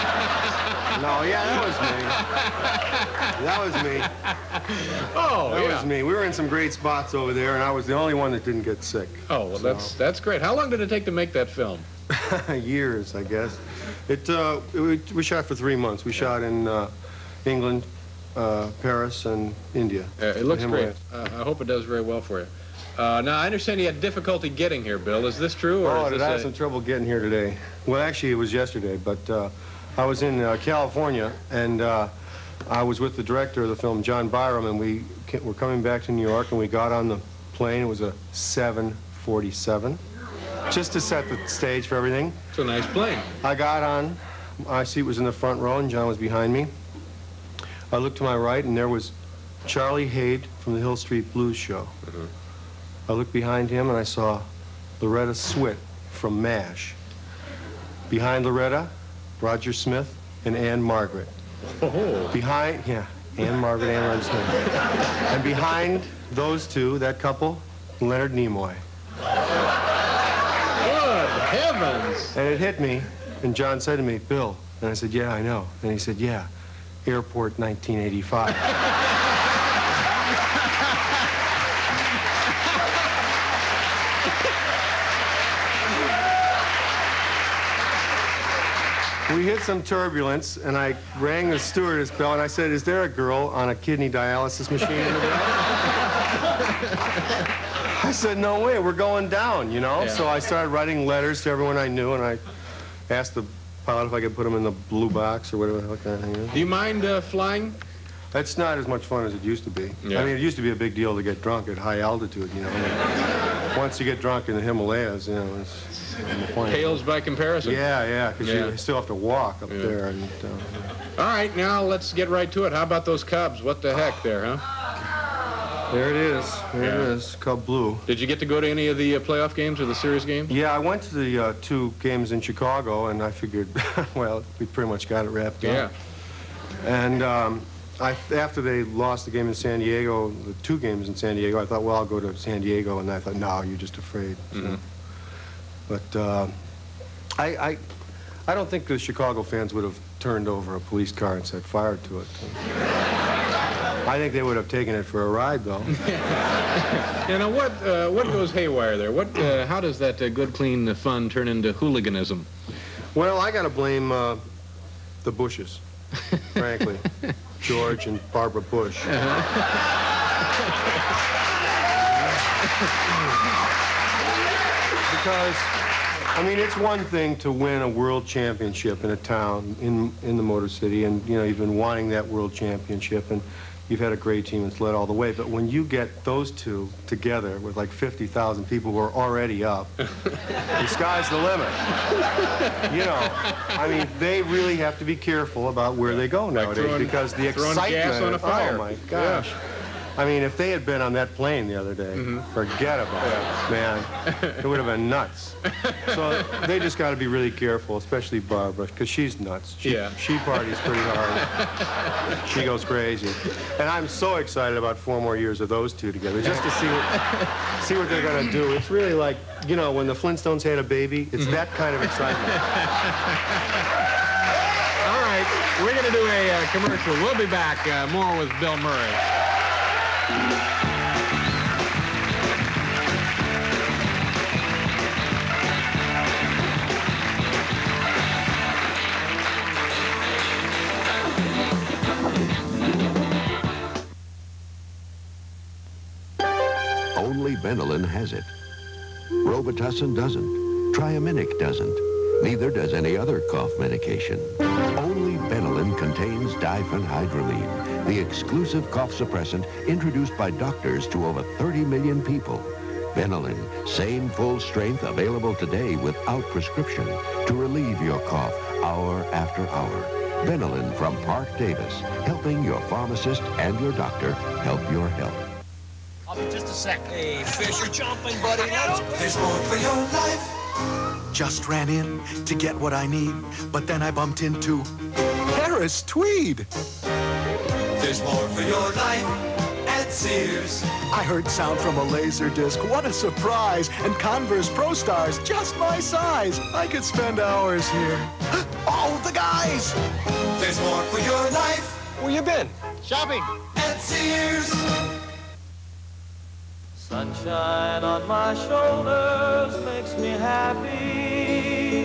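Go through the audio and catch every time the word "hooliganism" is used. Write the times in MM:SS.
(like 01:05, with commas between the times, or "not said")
02:41.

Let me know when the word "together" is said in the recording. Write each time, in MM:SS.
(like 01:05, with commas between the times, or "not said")
03:07, 03:36.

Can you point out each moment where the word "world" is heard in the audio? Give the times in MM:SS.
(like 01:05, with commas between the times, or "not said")
02:57, 03:02.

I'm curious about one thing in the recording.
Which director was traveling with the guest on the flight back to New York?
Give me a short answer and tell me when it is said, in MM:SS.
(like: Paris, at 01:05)
John Byrum, at 00:34.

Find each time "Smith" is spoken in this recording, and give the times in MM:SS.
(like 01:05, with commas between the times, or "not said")
00:59, 01:04.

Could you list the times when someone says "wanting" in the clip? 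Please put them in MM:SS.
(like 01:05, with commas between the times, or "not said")
03:01.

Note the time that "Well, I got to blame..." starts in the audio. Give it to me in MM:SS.
02:43.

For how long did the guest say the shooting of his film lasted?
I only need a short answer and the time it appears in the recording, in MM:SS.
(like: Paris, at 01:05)
3 months, at 00:15.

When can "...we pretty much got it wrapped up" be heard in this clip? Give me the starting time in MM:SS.
02:14.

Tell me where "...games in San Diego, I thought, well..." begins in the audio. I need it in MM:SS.
02:20.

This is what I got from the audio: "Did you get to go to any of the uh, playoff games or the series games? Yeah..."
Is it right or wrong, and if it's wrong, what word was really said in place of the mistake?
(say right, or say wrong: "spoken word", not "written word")
right.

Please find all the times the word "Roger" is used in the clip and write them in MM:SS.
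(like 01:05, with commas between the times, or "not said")
00:59, 01:04.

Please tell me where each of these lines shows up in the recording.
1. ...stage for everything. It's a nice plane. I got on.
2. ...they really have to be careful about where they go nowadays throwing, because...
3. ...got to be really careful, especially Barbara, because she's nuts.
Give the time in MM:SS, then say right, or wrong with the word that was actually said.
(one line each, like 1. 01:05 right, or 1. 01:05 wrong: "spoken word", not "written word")
1. 00:41 right
2. 03:14 right
3. 03:26 right.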